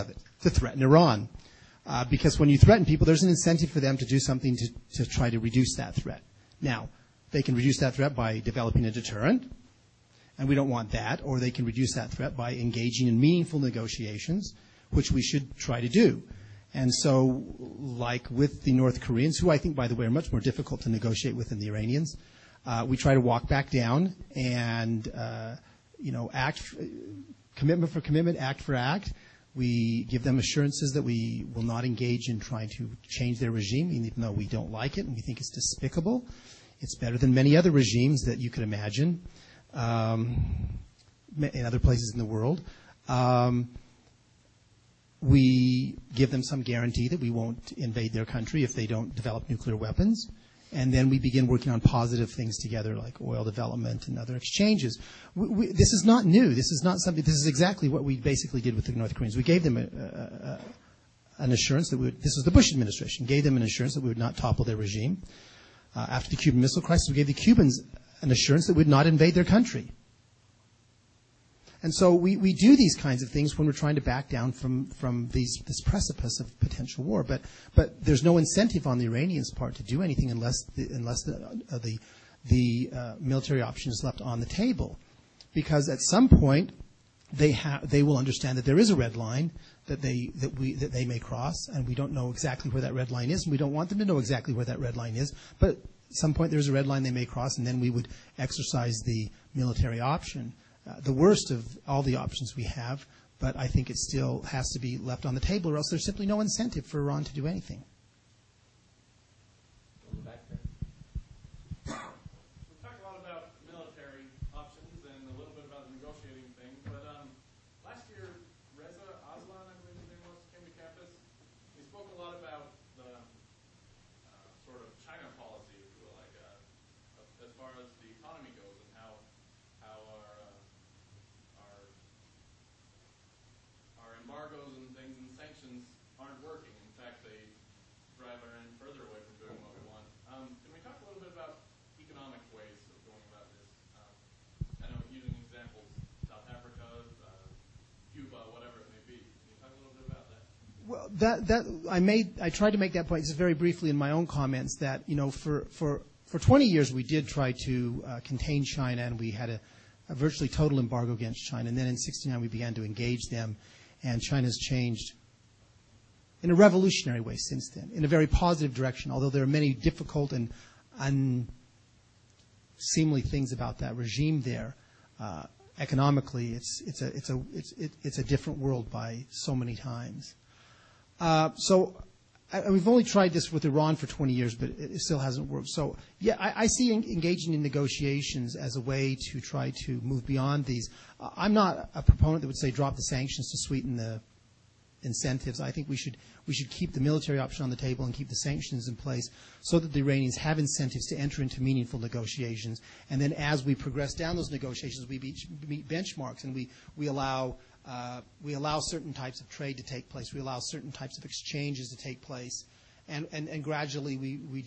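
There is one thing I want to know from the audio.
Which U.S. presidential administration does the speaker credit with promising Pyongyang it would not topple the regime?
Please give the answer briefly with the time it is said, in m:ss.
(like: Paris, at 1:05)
Bush administration, at 1:02.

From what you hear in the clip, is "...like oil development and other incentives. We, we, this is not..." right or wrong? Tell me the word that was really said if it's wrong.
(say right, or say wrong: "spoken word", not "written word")
wrong: "exchanges", not "incentives".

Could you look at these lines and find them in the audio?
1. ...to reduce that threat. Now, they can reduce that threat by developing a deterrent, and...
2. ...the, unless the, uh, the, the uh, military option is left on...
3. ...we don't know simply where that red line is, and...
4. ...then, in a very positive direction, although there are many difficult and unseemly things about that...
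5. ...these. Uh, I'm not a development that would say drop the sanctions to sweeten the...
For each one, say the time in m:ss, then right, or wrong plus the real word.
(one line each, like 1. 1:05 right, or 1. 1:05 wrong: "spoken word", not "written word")
1. 0:05 right
2. 1:20 right
3. 1:31 wrong: "exactly", not "simply"
4. 2:47 right
5. 3:10 wrong: "proponent", not "development".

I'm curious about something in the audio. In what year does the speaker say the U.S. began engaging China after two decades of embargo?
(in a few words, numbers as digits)
1969.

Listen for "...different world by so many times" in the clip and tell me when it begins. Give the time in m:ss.
2:58.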